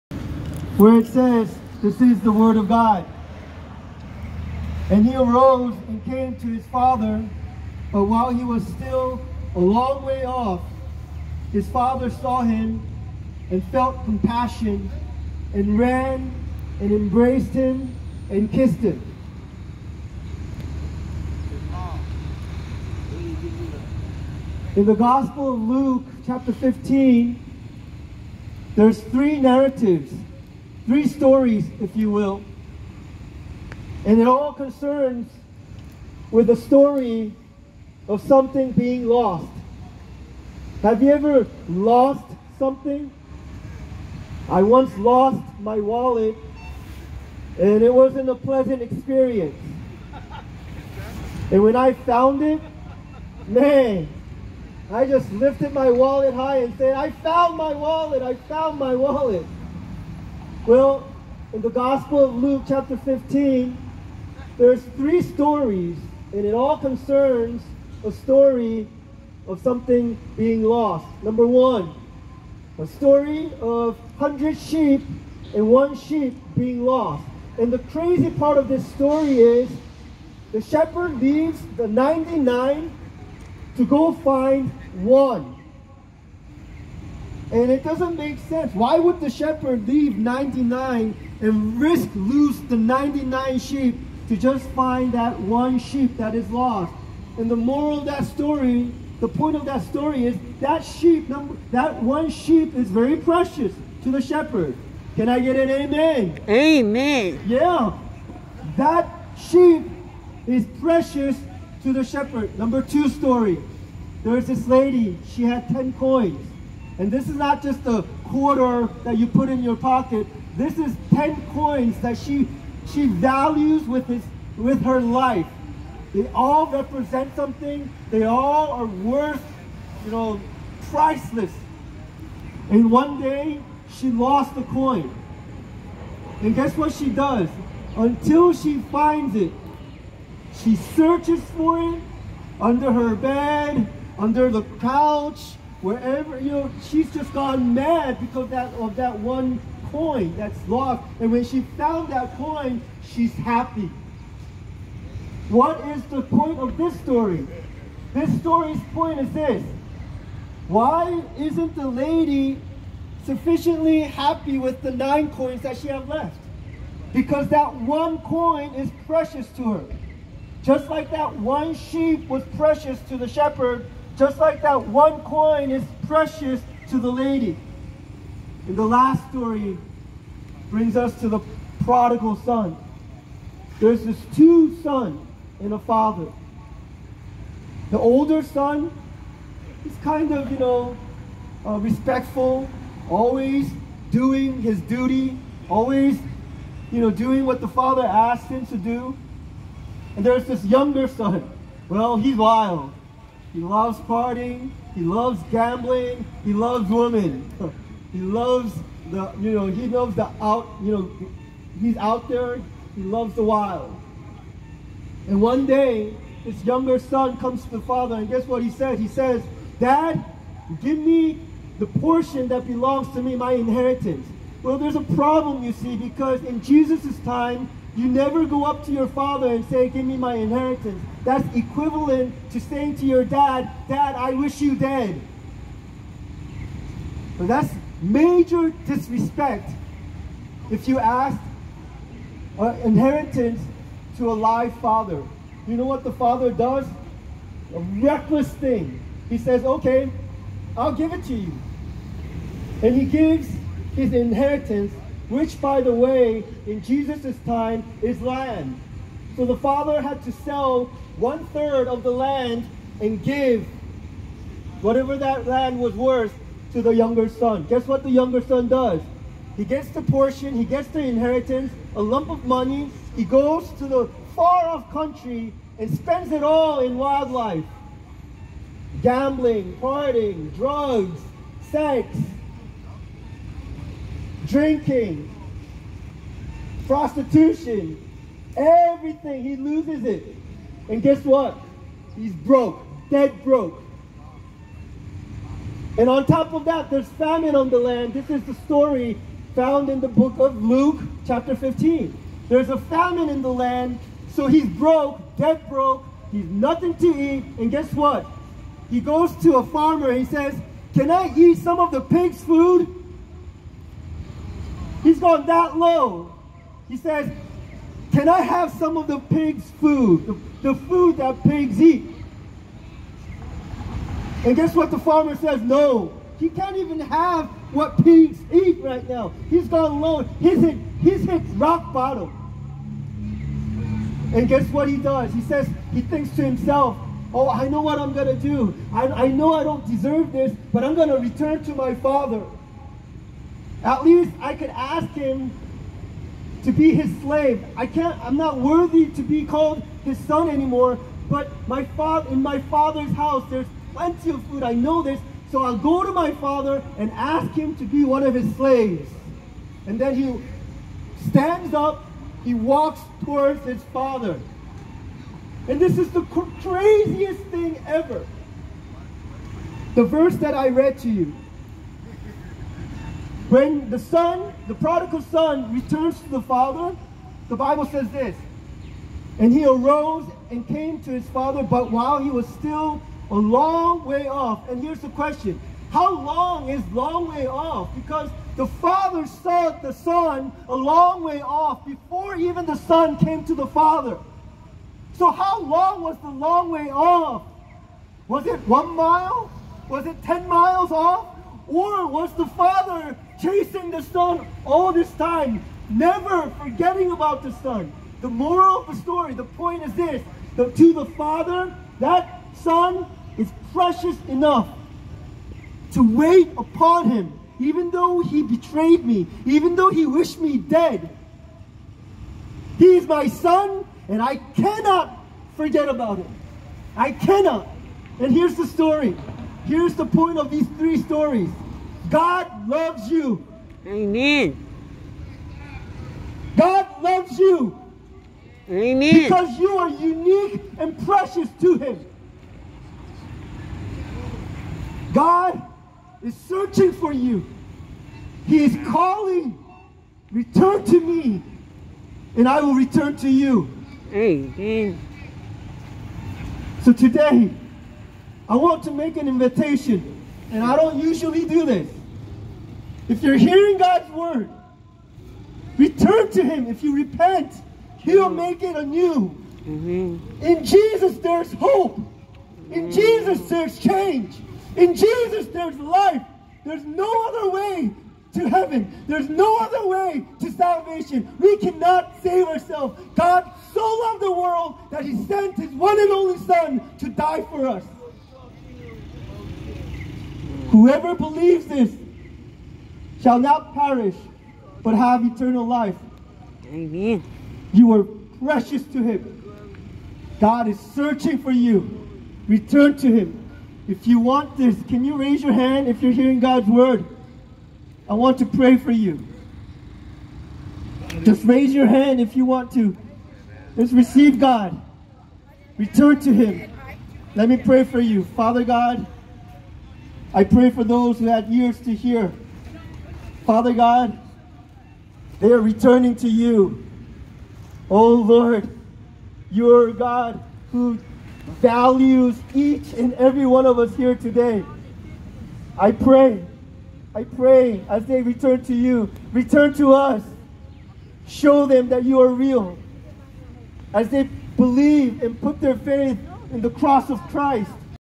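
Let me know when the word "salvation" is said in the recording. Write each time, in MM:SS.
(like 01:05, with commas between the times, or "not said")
08:00.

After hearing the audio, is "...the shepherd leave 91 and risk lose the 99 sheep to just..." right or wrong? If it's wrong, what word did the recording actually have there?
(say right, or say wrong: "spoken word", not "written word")
wrong: "99", not "91".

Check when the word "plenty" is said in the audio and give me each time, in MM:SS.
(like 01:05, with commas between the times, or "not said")
05:53.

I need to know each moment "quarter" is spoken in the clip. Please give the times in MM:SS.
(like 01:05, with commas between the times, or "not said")
01:58.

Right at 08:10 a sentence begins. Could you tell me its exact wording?
Whoever believes this shall not perish, but have eternal life.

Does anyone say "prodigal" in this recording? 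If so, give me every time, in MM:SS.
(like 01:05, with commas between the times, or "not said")
03:01, 06:14.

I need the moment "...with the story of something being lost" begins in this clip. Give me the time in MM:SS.
00:36.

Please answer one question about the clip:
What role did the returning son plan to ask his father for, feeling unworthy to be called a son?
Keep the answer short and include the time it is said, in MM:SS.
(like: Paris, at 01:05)
slave, at 05:58.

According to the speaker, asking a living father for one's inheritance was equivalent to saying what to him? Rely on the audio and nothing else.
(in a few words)
I wish you dead.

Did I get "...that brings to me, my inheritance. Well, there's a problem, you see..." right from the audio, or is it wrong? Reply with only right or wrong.
wrong.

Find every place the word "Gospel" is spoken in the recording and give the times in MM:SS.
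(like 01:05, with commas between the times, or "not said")
00:24, 01:01.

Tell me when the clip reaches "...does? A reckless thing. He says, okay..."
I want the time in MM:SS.
04:06.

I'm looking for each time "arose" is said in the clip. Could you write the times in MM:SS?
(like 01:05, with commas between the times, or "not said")
00:05, 06:19.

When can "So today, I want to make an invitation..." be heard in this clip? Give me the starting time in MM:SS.
07:36.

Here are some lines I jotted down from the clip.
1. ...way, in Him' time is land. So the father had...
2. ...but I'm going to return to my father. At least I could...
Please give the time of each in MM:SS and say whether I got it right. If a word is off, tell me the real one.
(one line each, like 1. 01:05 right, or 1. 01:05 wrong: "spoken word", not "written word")
1. 04:15 wrong: "Jesus", not "Him"
2. 05:40 right.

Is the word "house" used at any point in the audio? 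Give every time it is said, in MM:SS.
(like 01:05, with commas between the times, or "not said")
05:53.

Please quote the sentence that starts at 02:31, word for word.
And when she found that coin, she's happy.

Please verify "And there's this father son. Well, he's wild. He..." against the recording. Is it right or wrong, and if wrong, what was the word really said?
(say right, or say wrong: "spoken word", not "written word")
wrong: "younger", not "father".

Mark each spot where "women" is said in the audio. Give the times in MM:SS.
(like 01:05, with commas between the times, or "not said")
03:26.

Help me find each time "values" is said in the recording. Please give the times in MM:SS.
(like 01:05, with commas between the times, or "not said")
02:03, 08:51.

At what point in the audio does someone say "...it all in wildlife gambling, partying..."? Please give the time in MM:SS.
04:36.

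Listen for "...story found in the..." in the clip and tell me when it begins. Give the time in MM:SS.
04:58.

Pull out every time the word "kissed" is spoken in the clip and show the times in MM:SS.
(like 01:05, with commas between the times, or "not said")
00:18.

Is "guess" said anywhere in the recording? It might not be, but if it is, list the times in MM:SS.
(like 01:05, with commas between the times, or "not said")
02:16, 03:38, 04:27, 04:51, 05:07, 05:24, 05:34.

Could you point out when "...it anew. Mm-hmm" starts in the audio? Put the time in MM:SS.
07:48.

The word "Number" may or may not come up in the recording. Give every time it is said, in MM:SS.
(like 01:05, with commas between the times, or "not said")
01:11, 01:52.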